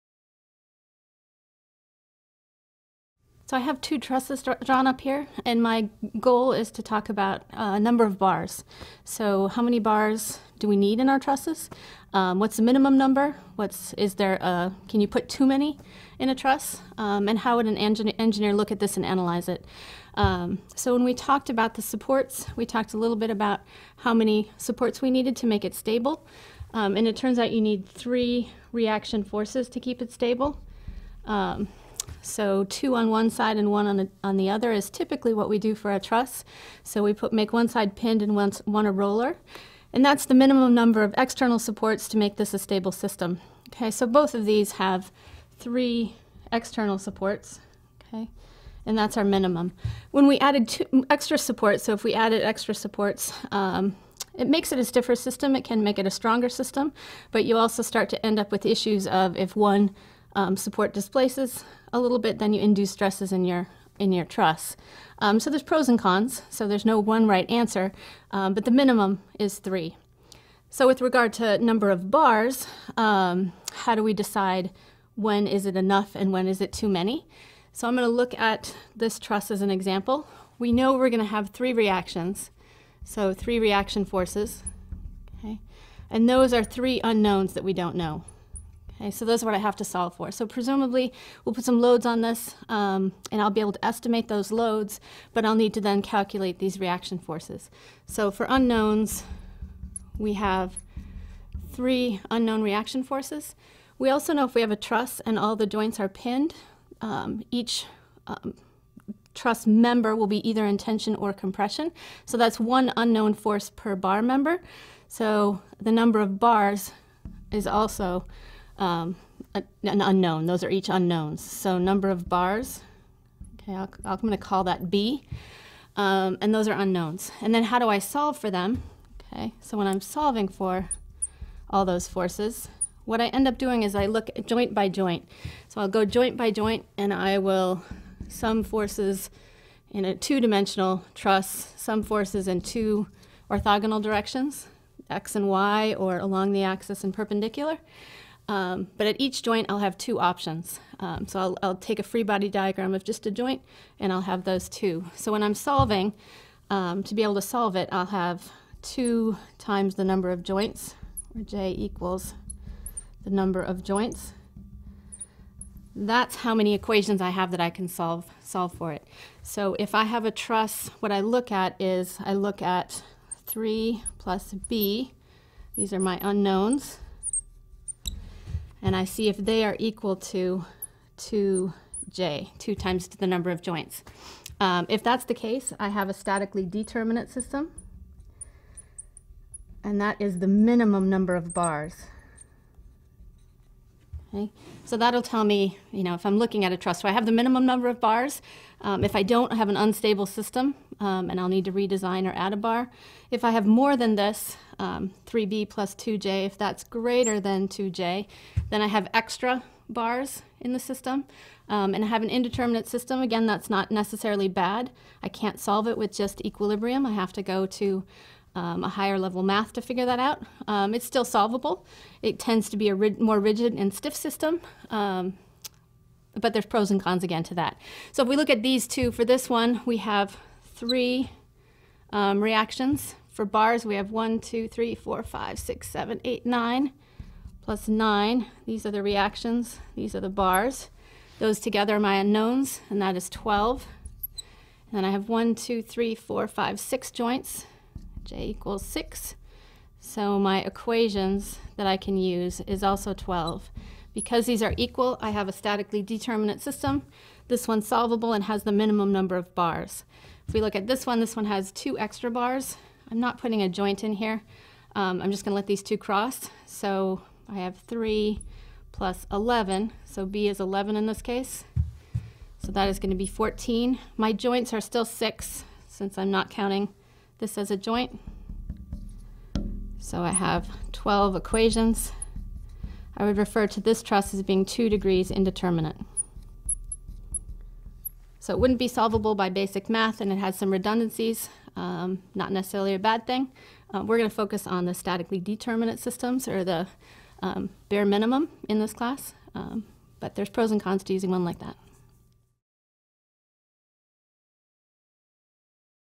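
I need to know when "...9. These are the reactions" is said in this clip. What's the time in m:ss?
3:57.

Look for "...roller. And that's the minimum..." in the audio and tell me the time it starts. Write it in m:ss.
0:38.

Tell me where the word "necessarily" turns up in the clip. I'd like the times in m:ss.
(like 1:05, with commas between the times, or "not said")
3:33, 4:52.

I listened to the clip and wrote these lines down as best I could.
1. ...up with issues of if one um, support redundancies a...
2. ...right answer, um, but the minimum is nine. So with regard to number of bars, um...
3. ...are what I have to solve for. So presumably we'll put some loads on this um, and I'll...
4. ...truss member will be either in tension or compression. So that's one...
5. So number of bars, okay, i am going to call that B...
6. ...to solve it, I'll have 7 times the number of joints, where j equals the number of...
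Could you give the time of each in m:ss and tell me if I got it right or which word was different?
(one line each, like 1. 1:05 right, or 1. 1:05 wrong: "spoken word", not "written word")
1. 0:58 wrong: "displaces", not "redundancies"
2. 1:07 wrong: "three", not "nine"
3. 1:29 right
4. 1:49 right
5. 2:01 right
6. 2:37 wrong: "2", not "7".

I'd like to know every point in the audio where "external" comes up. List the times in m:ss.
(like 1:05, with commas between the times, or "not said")
0:41, 0:46.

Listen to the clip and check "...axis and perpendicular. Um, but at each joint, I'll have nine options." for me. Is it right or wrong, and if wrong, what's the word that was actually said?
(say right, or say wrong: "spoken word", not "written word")
wrong: "two", not "nine".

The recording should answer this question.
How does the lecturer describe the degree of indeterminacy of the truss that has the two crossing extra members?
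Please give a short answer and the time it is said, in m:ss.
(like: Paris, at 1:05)
Two degrees indeterminate, at 4:44.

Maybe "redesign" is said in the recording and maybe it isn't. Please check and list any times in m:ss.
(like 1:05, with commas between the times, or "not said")
3:21.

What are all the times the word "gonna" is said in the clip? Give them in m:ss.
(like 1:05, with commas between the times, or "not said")
4:25, 4:32.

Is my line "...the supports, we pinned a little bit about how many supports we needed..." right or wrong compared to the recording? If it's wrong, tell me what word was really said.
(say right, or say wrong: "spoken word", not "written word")
wrong: "talked", not "pinned".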